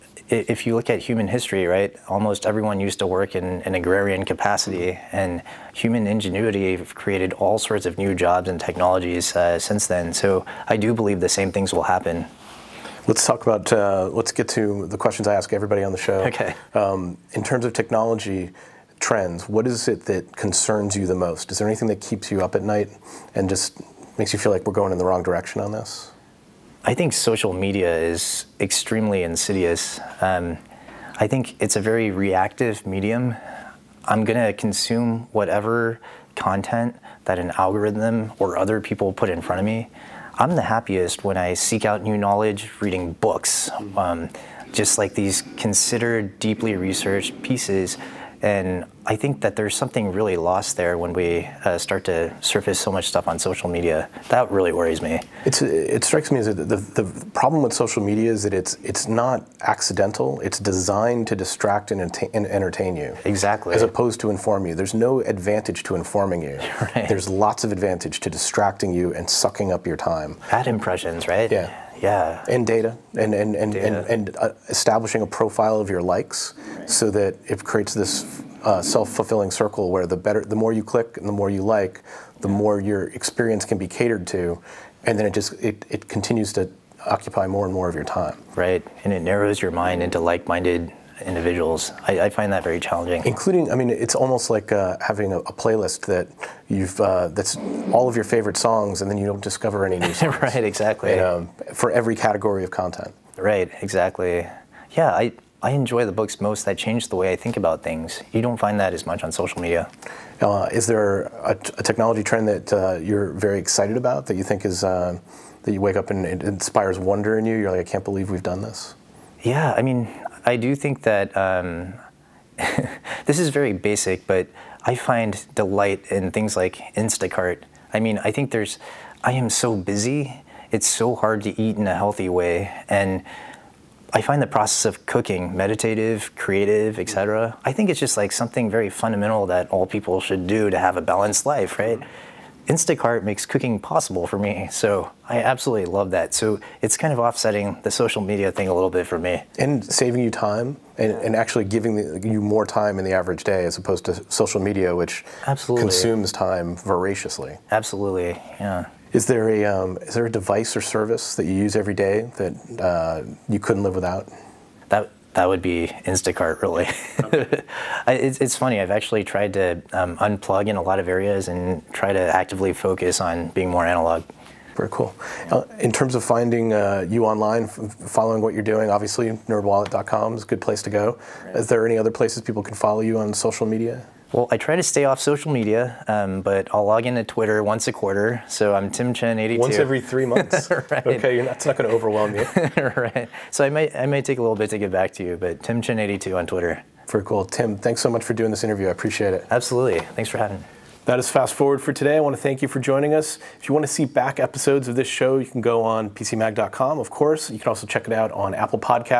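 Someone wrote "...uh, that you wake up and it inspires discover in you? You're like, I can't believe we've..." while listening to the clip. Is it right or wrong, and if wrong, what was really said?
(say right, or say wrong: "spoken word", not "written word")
wrong: "wonder", not "discover".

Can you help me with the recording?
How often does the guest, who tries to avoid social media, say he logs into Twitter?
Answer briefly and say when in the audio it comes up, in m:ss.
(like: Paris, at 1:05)
once a quarter, at 3:07.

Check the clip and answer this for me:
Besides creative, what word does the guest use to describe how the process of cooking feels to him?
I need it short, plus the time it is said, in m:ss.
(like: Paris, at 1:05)
meditative, at 2:15.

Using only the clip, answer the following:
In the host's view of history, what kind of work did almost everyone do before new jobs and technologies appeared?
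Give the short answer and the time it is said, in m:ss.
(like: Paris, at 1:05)
agrarian, at 0:03.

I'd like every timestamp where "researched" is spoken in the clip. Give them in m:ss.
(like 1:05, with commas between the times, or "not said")
0:46.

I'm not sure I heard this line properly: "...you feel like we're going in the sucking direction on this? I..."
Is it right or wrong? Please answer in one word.
wrong.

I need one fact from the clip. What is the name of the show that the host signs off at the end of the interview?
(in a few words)
Fast Forward.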